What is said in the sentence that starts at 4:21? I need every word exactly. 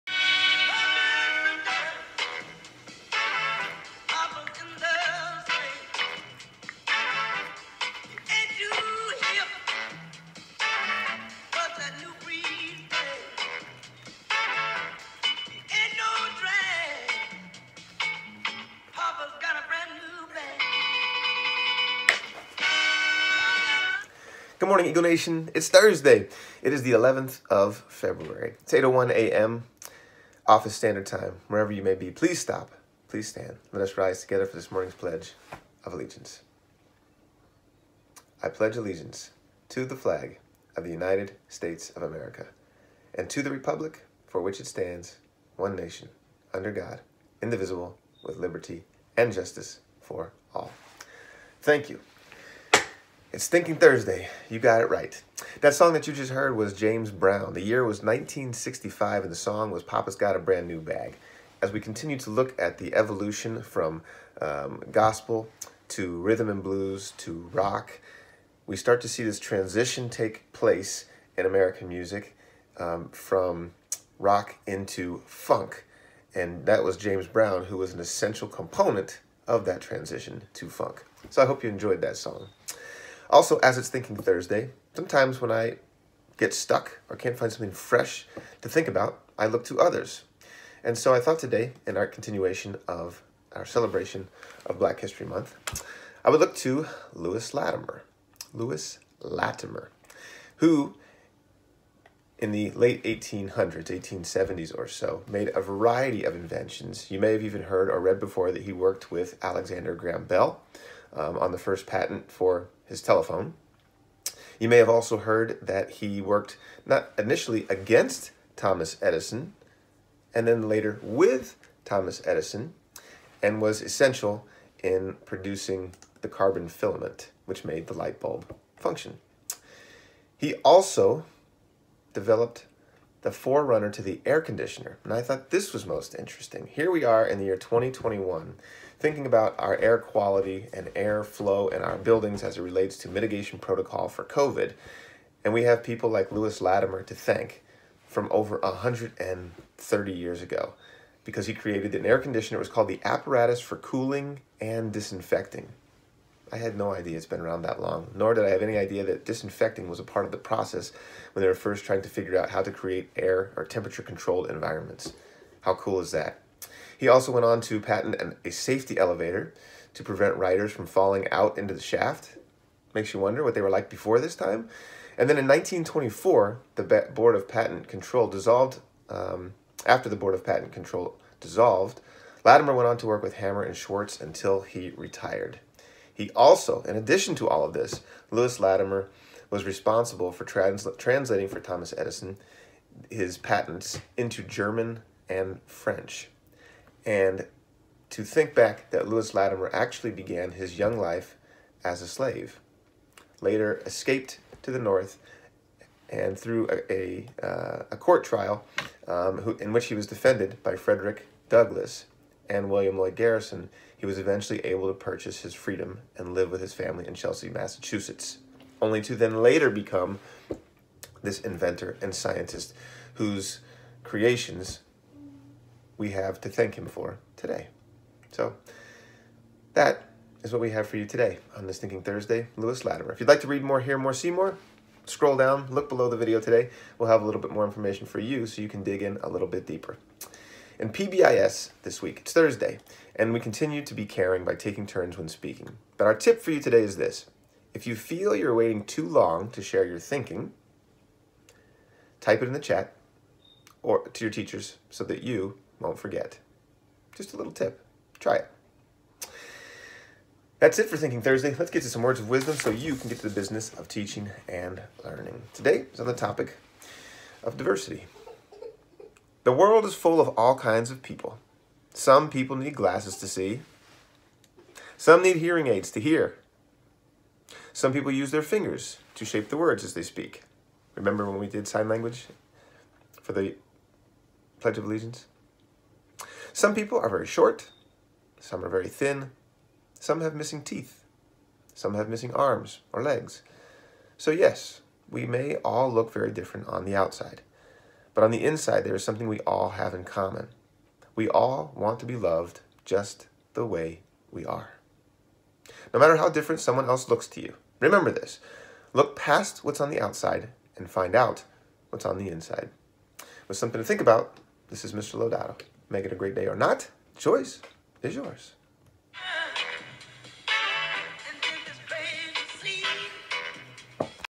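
Let's get to some words of wisdom so you can get to the business of teaching and learning.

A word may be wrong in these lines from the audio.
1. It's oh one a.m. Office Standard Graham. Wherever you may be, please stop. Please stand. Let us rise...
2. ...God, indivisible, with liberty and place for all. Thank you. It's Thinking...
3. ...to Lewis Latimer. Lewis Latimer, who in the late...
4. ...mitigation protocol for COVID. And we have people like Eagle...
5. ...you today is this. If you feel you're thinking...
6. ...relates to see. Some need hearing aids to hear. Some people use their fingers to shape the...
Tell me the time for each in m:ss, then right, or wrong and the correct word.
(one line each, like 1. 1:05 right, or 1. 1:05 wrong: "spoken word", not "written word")
1. 0:28 wrong: "Time", not "Graham"
2. 0:46 wrong: "justice", not "place"
3. 1:36 right
4. 2:23 wrong: "Lewis", not "Eagle"
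5. 4:06 wrong: "waiting", not "thinking"
6. 4:32 wrong: "glasses", not "relates".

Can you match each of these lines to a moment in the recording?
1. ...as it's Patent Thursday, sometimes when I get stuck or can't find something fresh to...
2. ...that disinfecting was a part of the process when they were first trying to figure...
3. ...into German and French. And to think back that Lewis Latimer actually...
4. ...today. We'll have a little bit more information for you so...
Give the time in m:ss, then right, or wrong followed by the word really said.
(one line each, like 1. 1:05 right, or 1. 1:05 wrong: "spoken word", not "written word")
1. 1:23 wrong: "Thinking", not "Patent"
2. 2:39 right
3. 3:14 right
4. 3:56 right.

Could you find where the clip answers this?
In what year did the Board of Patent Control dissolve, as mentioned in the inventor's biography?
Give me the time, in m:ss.
2:55.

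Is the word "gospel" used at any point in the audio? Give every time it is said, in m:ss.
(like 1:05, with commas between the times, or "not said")
1:04.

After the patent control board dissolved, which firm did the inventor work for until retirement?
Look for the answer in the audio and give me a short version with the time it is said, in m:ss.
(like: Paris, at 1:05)
Hammer and Schwarz, at 3:03.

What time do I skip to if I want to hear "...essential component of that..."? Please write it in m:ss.
1:18.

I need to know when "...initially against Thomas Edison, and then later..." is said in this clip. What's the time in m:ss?
1:57.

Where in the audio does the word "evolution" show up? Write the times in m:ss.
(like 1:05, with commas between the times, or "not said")
1:02.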